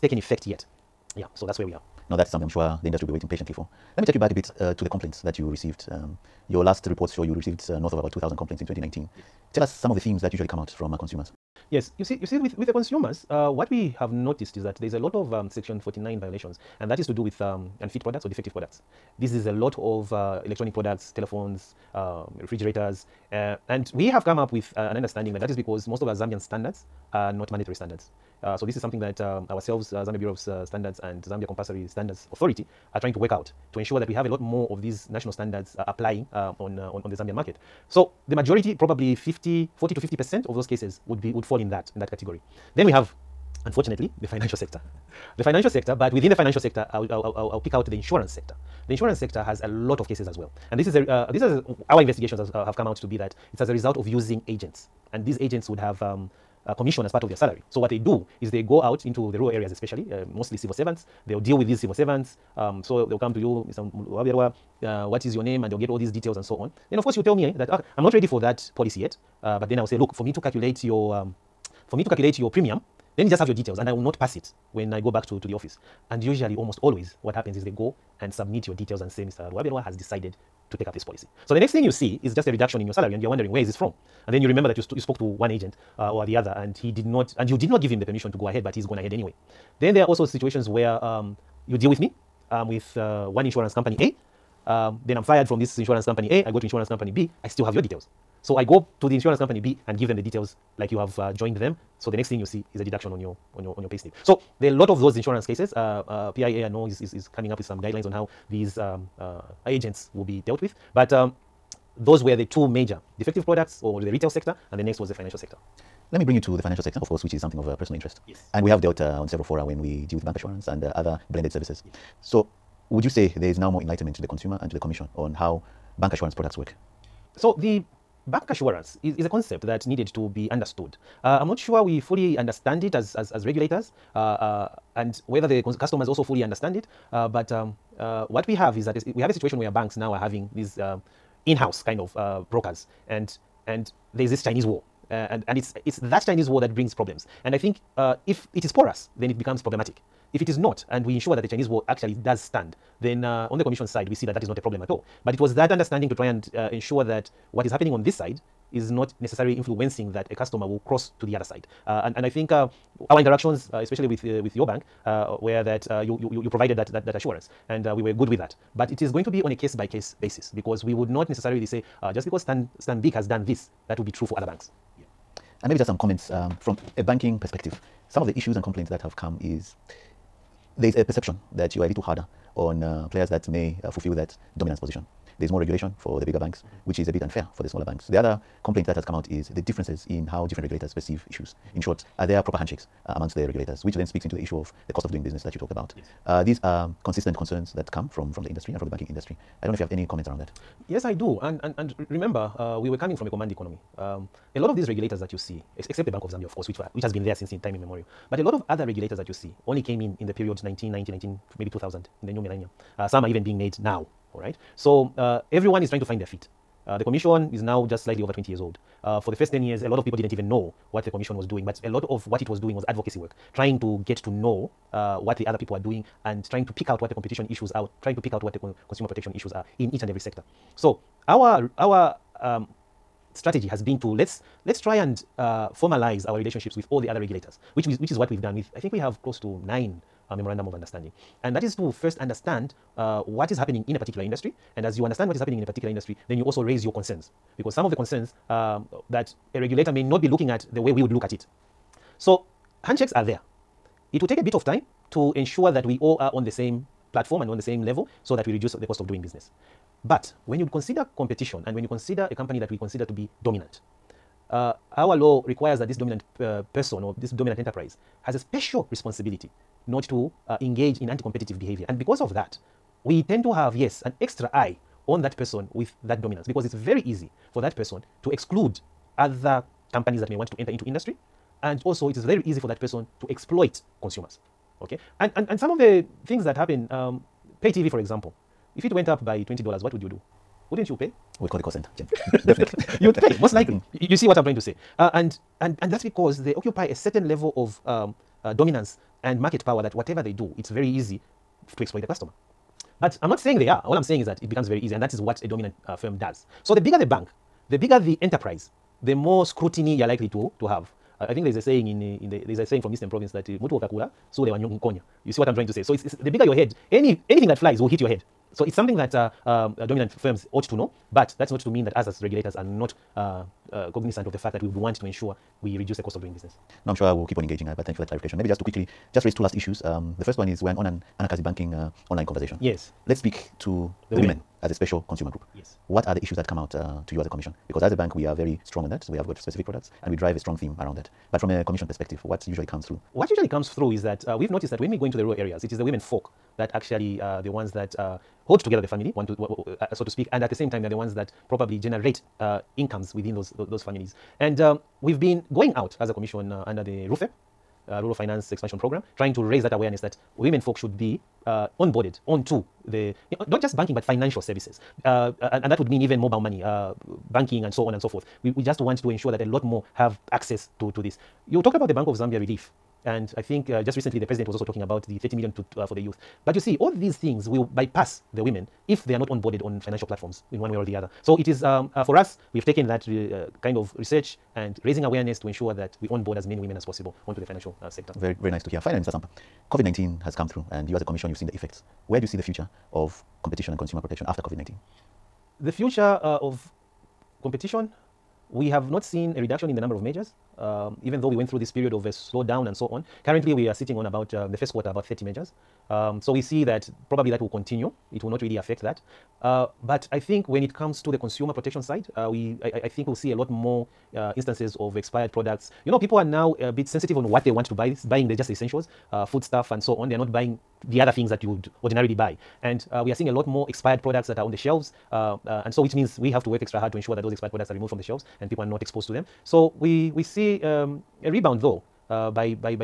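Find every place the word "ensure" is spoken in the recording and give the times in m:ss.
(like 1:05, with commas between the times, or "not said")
0:33, 2:31, 2:36, 4:15, 5:25, 6:09, 6:25, 7:06.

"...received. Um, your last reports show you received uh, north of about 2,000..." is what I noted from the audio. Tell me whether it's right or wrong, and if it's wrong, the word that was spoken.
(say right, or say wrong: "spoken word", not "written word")
right.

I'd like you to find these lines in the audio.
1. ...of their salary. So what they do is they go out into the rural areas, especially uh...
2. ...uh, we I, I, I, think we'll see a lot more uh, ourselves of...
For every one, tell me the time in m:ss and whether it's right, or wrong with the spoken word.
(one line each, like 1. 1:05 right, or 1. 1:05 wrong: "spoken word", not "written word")
1. 0:57 right
2. 6:52 wrong: "instances", not "ourselves".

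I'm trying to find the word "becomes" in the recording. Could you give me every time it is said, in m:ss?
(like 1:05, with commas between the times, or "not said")
2:29, 5:04.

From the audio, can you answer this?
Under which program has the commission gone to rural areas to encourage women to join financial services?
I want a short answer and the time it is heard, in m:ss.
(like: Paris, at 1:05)
Rural Finance Expansion Program, at 5:58.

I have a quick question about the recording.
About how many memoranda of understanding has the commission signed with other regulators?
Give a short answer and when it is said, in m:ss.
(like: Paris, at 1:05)
9, at 3:59.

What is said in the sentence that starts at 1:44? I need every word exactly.
So there are a lot of those insurance cases.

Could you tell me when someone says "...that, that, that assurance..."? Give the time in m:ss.
2:46.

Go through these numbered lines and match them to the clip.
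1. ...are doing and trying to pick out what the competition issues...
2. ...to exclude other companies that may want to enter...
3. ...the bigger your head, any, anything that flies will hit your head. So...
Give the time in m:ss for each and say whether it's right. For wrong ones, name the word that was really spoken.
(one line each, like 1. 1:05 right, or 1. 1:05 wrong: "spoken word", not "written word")
1. 3:45 right
2. 4:38 right
3. 5:16 right.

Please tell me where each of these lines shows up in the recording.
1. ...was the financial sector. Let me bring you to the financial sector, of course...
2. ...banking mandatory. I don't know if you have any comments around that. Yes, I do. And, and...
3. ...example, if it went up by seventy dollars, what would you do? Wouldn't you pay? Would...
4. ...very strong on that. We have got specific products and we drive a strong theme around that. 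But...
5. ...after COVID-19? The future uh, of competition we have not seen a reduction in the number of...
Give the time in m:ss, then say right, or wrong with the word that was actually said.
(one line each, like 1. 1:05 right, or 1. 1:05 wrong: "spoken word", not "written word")
1. 1:55 right
2. 3:18 wrong: "industry", not "mandatory"
3. 4:47 wrong: "twenty", not "seventy"
4. 5:38 right
5. 6:34 right.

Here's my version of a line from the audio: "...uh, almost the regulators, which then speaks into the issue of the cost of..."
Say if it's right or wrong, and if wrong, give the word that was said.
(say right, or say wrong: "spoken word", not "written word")
wrong: "amongst", not "almost".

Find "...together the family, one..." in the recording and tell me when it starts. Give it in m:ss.
5:48.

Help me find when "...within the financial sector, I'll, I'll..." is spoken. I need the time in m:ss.
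0:46.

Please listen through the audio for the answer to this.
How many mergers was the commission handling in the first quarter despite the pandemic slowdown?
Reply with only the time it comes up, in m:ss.
6:45.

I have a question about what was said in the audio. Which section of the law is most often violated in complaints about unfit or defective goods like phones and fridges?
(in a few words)
Section 49.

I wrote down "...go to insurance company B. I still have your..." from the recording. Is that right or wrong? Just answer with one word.
right.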